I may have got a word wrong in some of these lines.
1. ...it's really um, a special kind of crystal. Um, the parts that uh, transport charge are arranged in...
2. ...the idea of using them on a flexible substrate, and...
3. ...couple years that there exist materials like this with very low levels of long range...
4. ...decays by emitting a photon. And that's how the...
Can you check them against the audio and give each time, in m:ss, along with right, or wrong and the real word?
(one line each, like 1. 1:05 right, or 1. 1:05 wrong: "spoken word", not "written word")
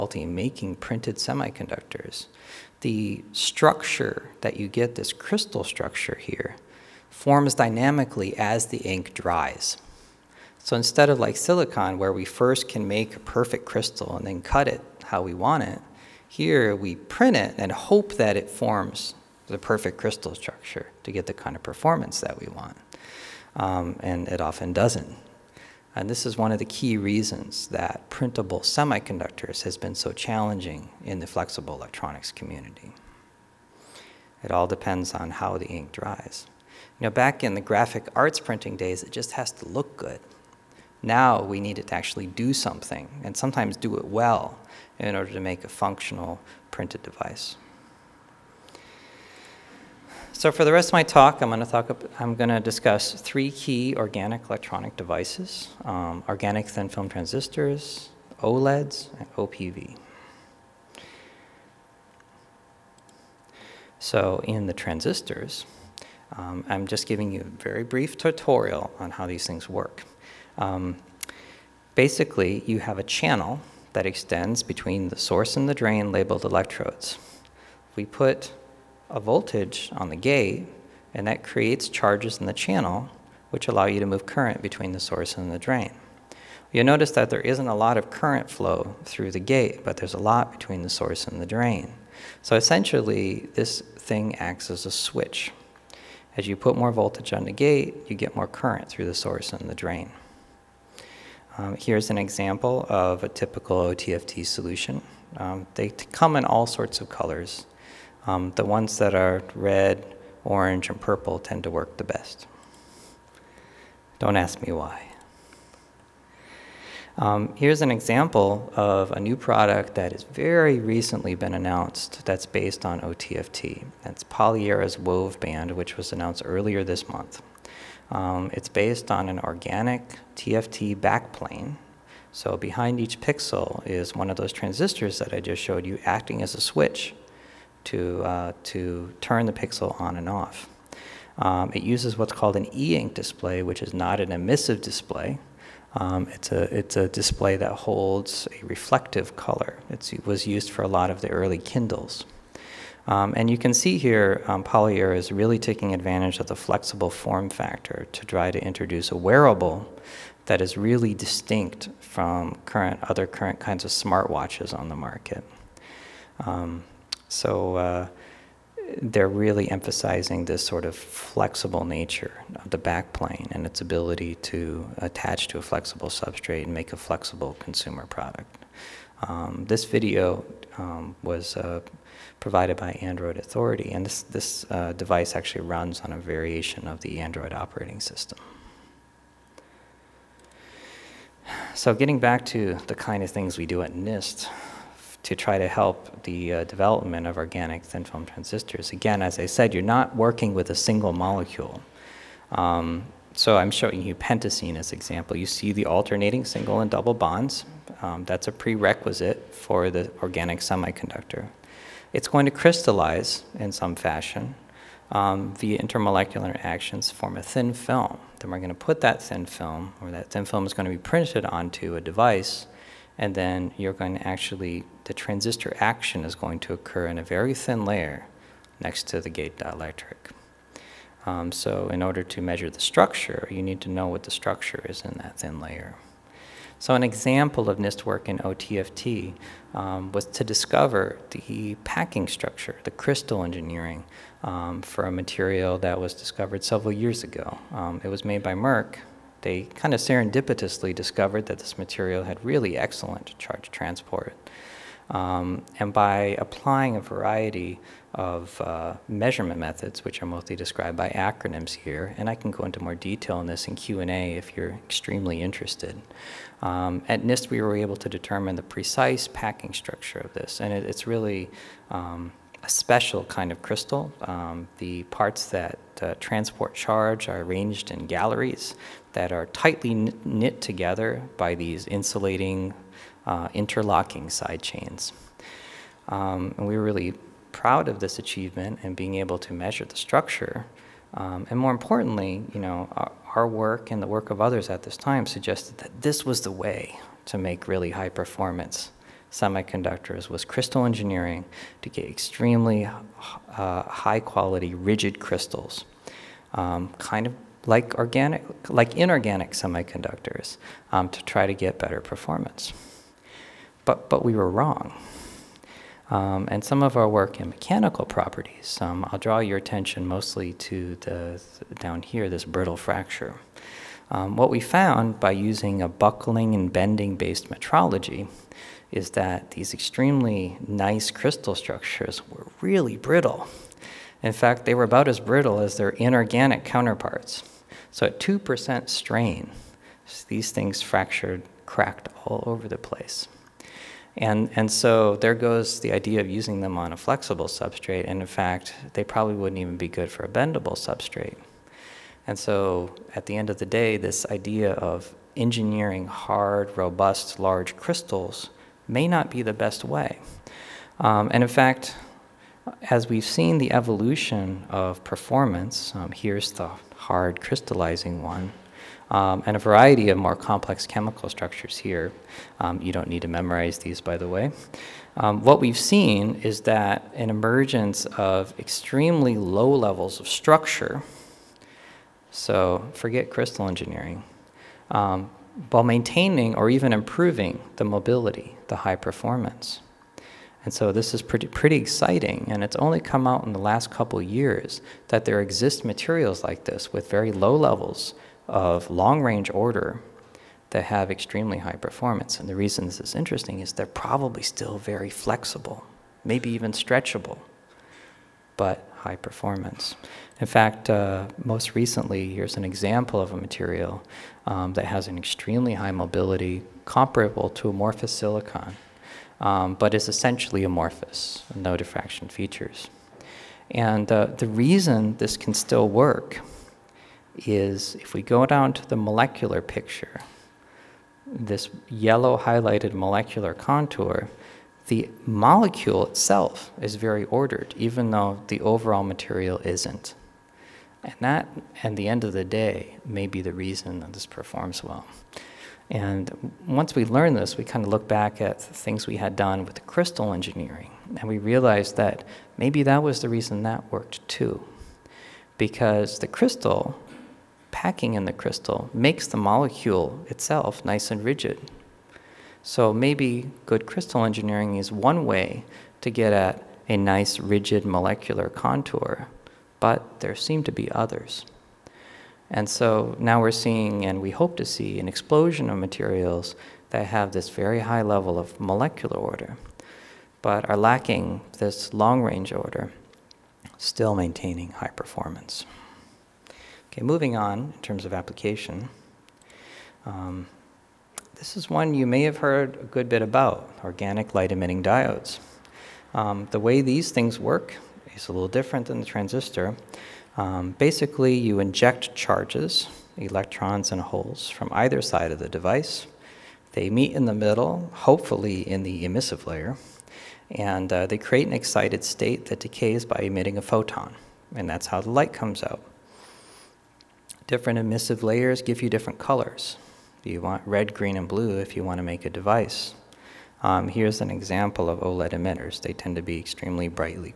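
1. 4:30 right
2. 5:45 right
3. 6:33 right
4. 8:32 right.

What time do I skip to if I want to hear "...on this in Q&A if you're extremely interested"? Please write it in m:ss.
4:23.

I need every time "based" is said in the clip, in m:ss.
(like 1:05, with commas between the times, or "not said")
2:02, 2:08, 5:27.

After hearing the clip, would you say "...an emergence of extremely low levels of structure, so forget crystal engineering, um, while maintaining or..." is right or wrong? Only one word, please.
right.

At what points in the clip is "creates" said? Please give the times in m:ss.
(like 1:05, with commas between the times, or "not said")
1:21, 8:31.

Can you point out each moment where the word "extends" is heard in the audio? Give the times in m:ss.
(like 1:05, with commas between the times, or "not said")
1:14.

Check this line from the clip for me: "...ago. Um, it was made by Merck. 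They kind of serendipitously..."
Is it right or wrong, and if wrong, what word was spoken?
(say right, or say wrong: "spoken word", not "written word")
right.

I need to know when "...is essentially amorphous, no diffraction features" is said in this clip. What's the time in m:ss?
6:59.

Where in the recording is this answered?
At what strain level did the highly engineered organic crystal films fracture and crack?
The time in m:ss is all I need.
5:38.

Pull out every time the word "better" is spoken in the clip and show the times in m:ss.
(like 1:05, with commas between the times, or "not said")
5:11.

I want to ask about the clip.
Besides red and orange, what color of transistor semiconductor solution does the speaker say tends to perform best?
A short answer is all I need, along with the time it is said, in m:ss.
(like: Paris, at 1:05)
Purple, at 1:50.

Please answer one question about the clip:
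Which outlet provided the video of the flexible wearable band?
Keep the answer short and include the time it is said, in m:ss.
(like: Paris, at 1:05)
Android Authority, at 3:02.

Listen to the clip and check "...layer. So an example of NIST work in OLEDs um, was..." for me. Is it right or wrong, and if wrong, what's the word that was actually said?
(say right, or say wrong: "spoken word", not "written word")
wrong: "OTFT", not "OLEDs".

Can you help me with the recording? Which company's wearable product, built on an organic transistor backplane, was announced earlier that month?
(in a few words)
Polyera.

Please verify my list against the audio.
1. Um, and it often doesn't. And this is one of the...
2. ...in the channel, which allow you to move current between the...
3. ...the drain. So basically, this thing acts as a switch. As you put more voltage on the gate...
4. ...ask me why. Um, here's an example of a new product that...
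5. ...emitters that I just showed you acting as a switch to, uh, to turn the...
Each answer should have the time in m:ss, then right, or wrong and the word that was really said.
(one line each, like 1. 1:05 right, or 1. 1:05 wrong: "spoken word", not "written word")
1. 0:23 right
2. 1:22 right
3. 1:31 wrong: "essentially", not "basically"
4. 1:54 right
5. 2:14 wrong: "transistors", not "emitters".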